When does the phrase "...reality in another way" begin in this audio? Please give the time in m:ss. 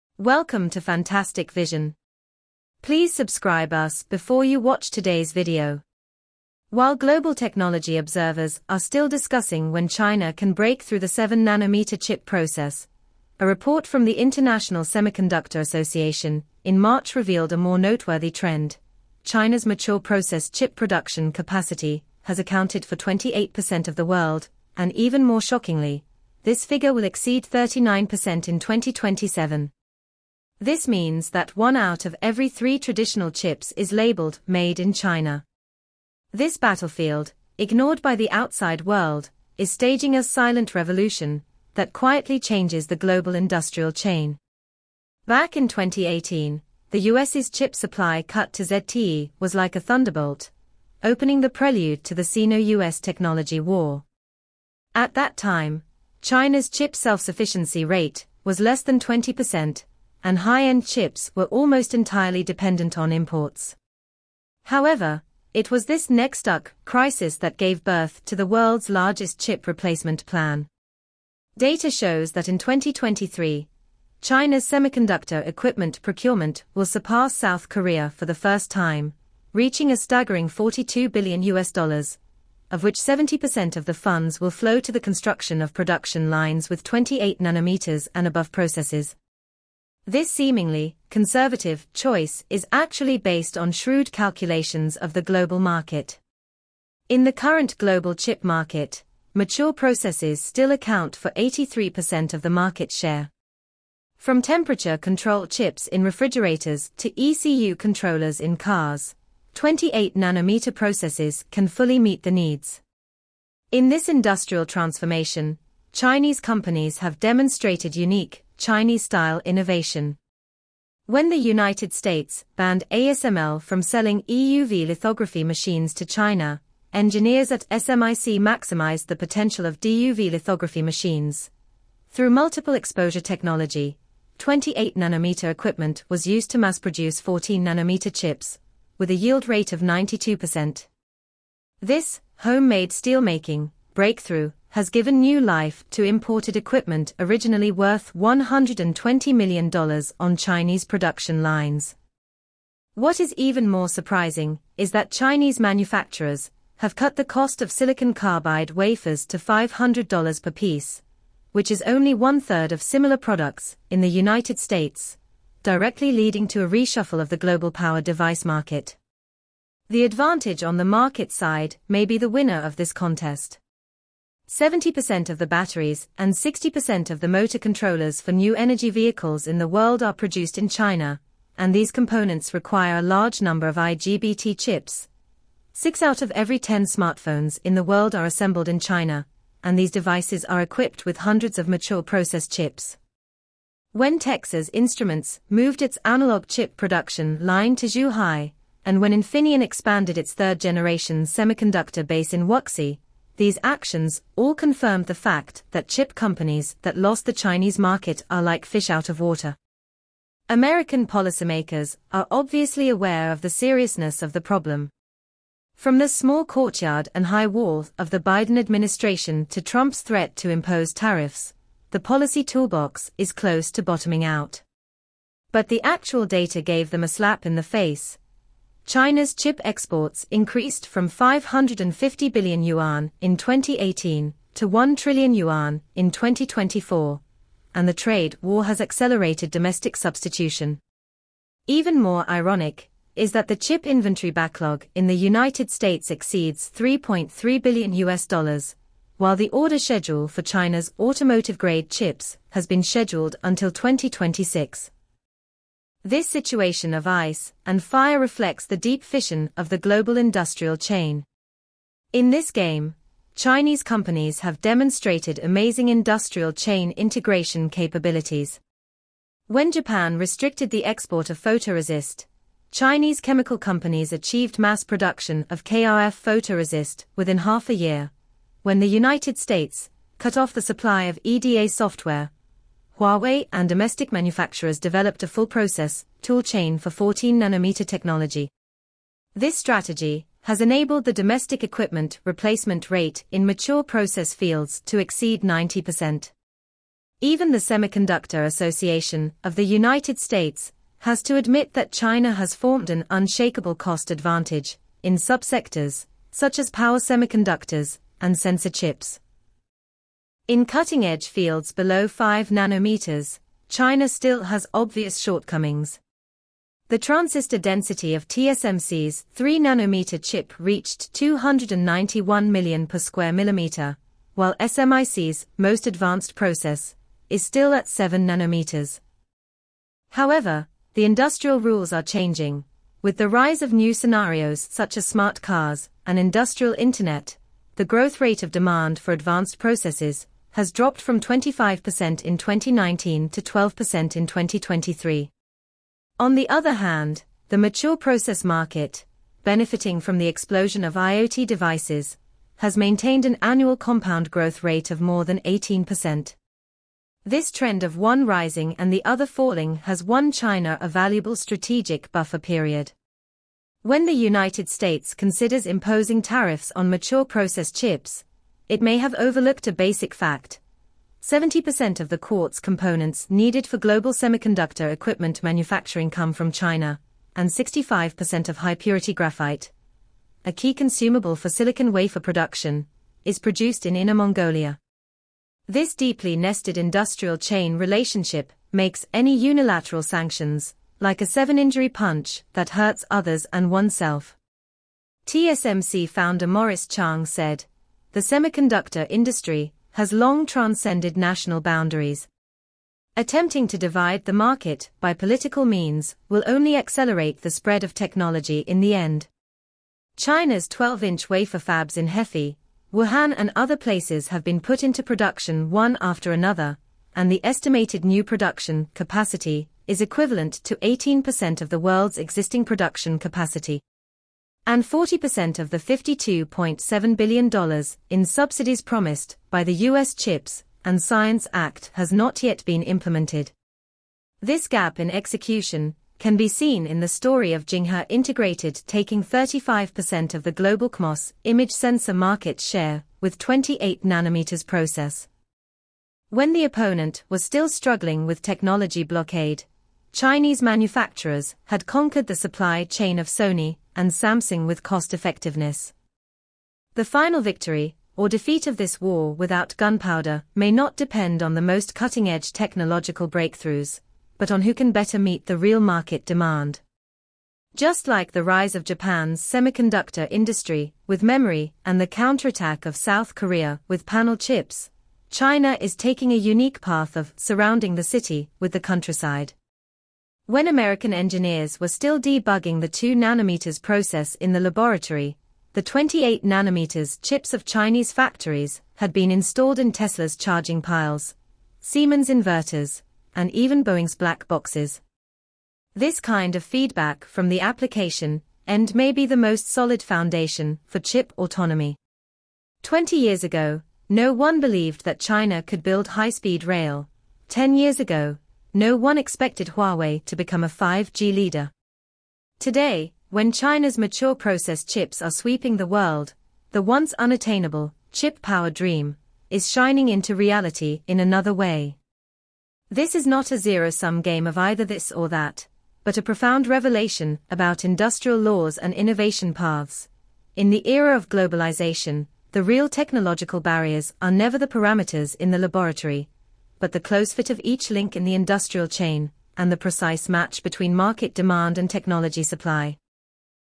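8:40.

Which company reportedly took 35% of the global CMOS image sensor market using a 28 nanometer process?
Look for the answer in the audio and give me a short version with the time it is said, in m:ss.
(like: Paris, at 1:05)
Jinghe Integrated, at 7:17.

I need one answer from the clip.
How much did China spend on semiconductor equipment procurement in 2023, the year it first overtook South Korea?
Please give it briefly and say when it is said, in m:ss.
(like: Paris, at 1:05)
$42 billion, at 1:20.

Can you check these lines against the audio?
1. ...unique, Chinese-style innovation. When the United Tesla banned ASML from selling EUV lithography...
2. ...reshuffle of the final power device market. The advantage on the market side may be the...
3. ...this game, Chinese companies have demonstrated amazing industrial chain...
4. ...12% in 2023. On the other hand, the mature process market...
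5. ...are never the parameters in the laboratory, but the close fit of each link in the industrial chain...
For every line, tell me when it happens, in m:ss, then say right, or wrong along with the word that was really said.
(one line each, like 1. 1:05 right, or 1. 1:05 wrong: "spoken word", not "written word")
1. 1:57 wrong: "States", not "Tesla"
2. 2:46 wrong: "global", not "final"
3. 4:22 right
4. 5:43 right
5. 8:54 right.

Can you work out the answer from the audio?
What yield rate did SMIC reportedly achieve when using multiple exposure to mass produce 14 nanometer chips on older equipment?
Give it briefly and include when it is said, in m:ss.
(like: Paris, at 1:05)
92%, at 2:19.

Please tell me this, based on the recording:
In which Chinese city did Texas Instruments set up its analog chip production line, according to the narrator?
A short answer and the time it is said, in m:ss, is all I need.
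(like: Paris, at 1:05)
Zhuhai, at 3:17.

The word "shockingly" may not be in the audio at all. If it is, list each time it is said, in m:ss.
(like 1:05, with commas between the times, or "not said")
0:25.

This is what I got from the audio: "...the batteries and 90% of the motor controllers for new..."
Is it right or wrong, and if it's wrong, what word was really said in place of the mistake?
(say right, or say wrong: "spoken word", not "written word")
wrong: "60", not "90".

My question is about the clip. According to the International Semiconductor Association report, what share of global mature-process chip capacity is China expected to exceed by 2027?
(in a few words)
39%.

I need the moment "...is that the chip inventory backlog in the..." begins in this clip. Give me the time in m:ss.
4:03.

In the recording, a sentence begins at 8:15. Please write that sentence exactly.
This kind of feedback from the application end may be the most solid foundation for chip autonomy.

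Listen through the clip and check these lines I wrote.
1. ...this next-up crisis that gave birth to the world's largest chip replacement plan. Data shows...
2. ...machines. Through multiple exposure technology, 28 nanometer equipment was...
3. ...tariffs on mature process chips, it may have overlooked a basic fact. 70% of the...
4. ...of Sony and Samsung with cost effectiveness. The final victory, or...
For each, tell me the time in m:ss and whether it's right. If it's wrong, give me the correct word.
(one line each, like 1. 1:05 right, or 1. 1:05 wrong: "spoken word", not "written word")
1. 1:05 right
2. 2:10 right
3. 6:06 right
4. 7:33 right.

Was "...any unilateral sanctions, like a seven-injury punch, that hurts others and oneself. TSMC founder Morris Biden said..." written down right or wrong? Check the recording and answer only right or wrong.
wrong.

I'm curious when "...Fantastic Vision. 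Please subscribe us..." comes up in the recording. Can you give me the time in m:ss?
0:00.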